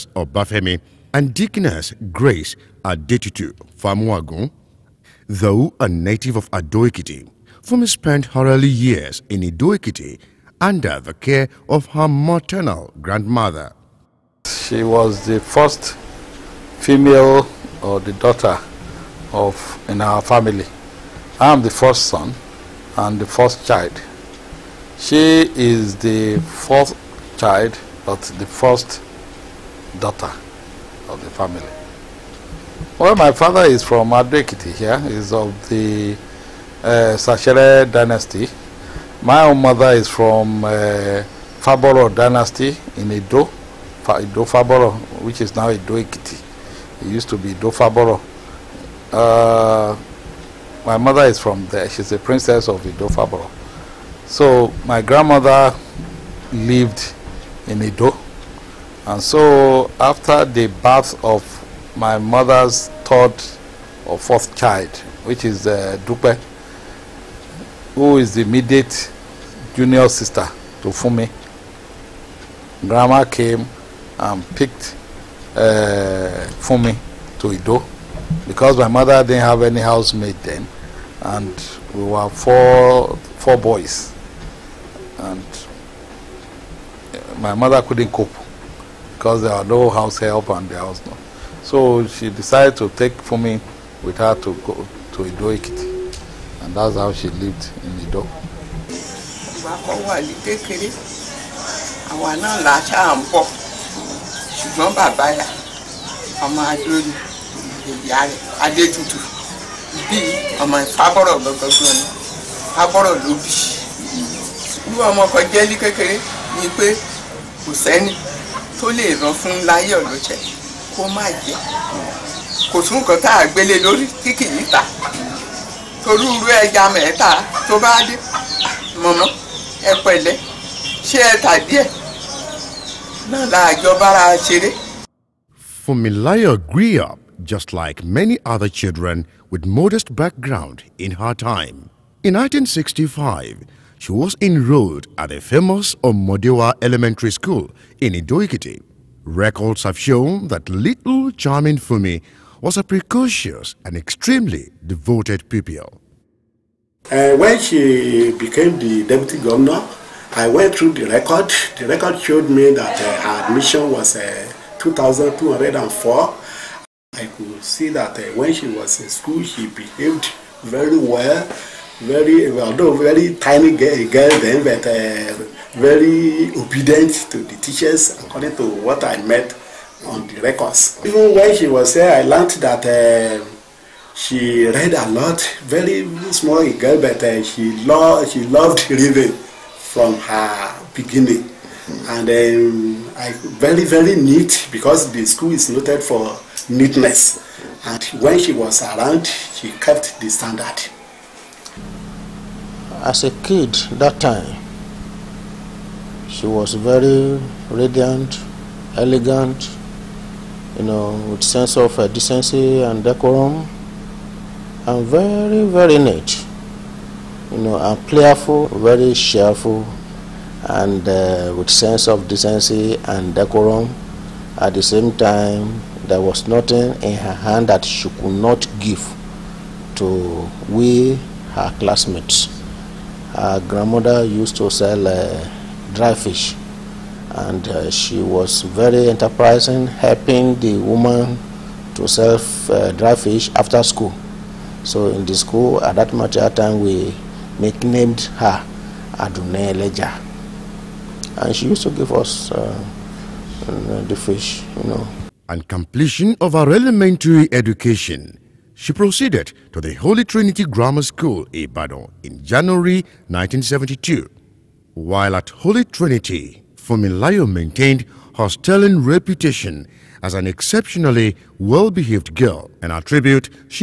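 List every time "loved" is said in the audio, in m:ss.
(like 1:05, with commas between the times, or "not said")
3:08.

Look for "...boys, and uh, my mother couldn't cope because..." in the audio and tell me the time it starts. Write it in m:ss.
1:23.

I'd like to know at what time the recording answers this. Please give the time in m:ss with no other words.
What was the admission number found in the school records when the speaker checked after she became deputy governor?
2:44.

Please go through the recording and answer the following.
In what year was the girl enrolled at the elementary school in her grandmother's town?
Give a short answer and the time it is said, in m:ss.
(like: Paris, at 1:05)
1965, at 2:22.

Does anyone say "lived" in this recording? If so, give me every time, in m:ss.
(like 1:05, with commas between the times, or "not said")
0:56, 1:37.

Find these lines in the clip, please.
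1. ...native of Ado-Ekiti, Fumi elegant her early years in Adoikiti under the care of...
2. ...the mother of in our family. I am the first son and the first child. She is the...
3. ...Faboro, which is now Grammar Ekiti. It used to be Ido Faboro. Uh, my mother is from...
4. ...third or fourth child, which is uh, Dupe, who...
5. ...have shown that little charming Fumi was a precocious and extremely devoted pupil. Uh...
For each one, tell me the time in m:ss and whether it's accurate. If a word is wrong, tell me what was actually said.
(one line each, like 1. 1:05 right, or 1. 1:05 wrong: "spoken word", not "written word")
1. 0:05 wrong: "spent", not "elegant"
2. 0:18 wrong: "daughter", not "mother"
3. 0:44 wrong: "Ido", not "Grammar"
4. 1:03 right
5. 2:29 right.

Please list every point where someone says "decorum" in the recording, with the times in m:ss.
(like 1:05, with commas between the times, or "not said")
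3:33, 3:43.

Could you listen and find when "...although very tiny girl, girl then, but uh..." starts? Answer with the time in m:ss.
2:52.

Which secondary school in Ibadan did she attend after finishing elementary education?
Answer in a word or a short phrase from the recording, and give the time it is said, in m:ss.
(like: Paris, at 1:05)
Holy Trinity Grammar School, at 4:19.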